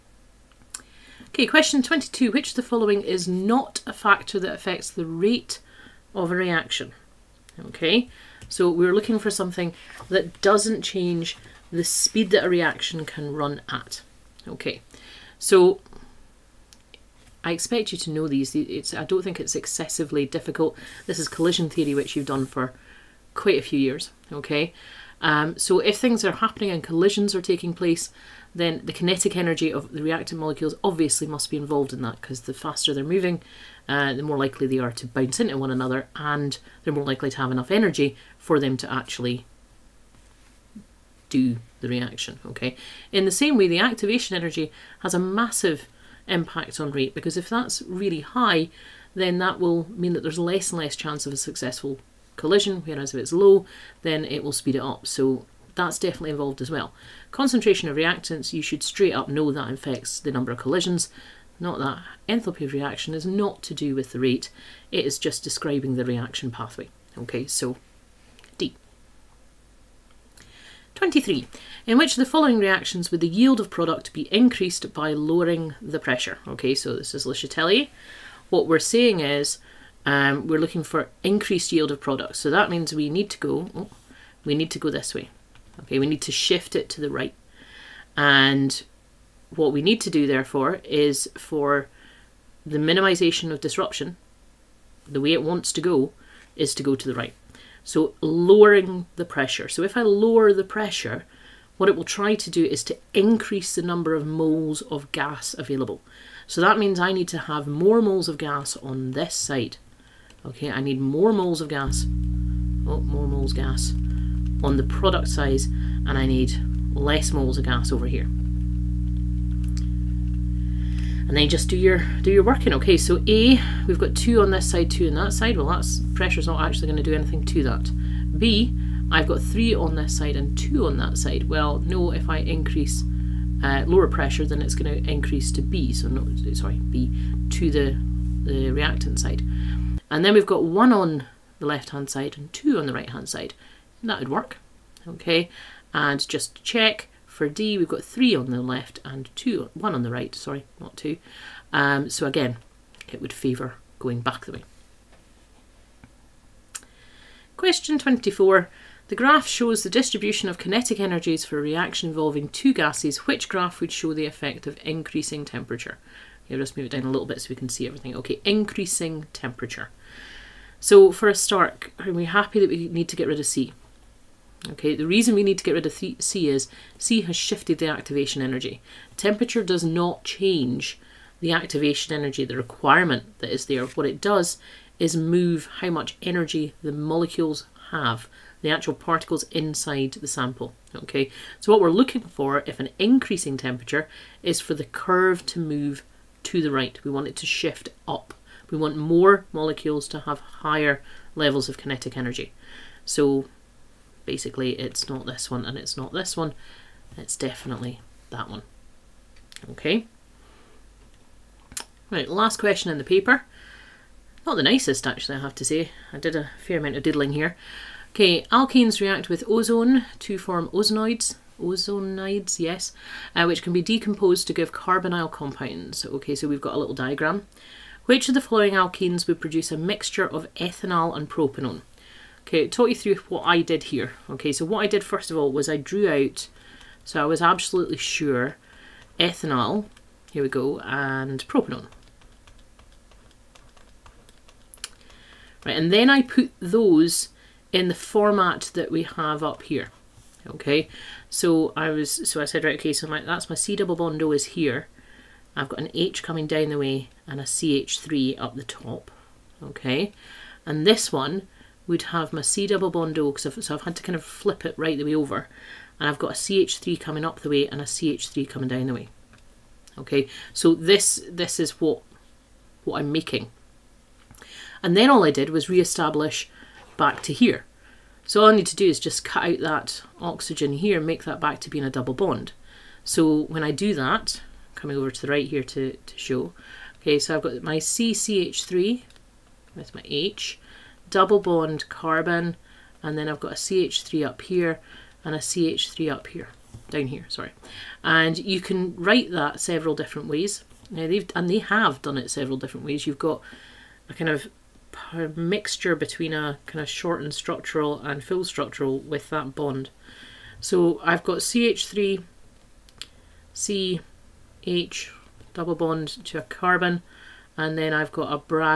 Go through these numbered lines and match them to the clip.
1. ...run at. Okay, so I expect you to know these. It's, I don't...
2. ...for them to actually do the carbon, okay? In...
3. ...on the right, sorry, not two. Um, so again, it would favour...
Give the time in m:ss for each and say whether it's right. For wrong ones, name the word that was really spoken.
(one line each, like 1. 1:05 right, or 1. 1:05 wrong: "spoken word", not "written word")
1. 0:13 right
2. 0:38 wrong: "reaction", not "carbon"
3. 2:29 right.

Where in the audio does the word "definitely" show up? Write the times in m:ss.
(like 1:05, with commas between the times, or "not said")
0:55, 3:27.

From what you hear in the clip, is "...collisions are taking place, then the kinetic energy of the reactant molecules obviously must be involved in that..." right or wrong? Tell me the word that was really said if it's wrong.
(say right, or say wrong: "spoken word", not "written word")
right.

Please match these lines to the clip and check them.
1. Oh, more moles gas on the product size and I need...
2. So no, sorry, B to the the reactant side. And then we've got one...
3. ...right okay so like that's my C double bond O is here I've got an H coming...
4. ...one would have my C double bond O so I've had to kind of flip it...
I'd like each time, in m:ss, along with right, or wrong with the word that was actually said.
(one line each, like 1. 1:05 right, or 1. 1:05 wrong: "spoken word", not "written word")
1. 1:52 right
2. 2:15 right
3. 4:12 right
4. 4:21 right.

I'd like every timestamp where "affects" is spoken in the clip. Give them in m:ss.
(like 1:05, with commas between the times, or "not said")
0:04, 0:59.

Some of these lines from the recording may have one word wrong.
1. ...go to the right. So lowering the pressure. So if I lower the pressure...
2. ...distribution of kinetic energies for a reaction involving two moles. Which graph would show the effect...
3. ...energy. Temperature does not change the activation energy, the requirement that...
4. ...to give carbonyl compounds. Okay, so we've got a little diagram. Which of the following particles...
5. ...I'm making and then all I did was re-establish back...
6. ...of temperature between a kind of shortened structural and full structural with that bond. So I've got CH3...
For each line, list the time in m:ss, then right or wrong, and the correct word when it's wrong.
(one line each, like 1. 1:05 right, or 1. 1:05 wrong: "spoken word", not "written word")
1. 1:36 right
2. 2:39 wrong: "gases", not "moles"
3. 2:58 right
4. 3:44 wrong: "alkenes", not "particles"
5. 4:32 right
6. 5:04 wrong: "mixture", not "temperature".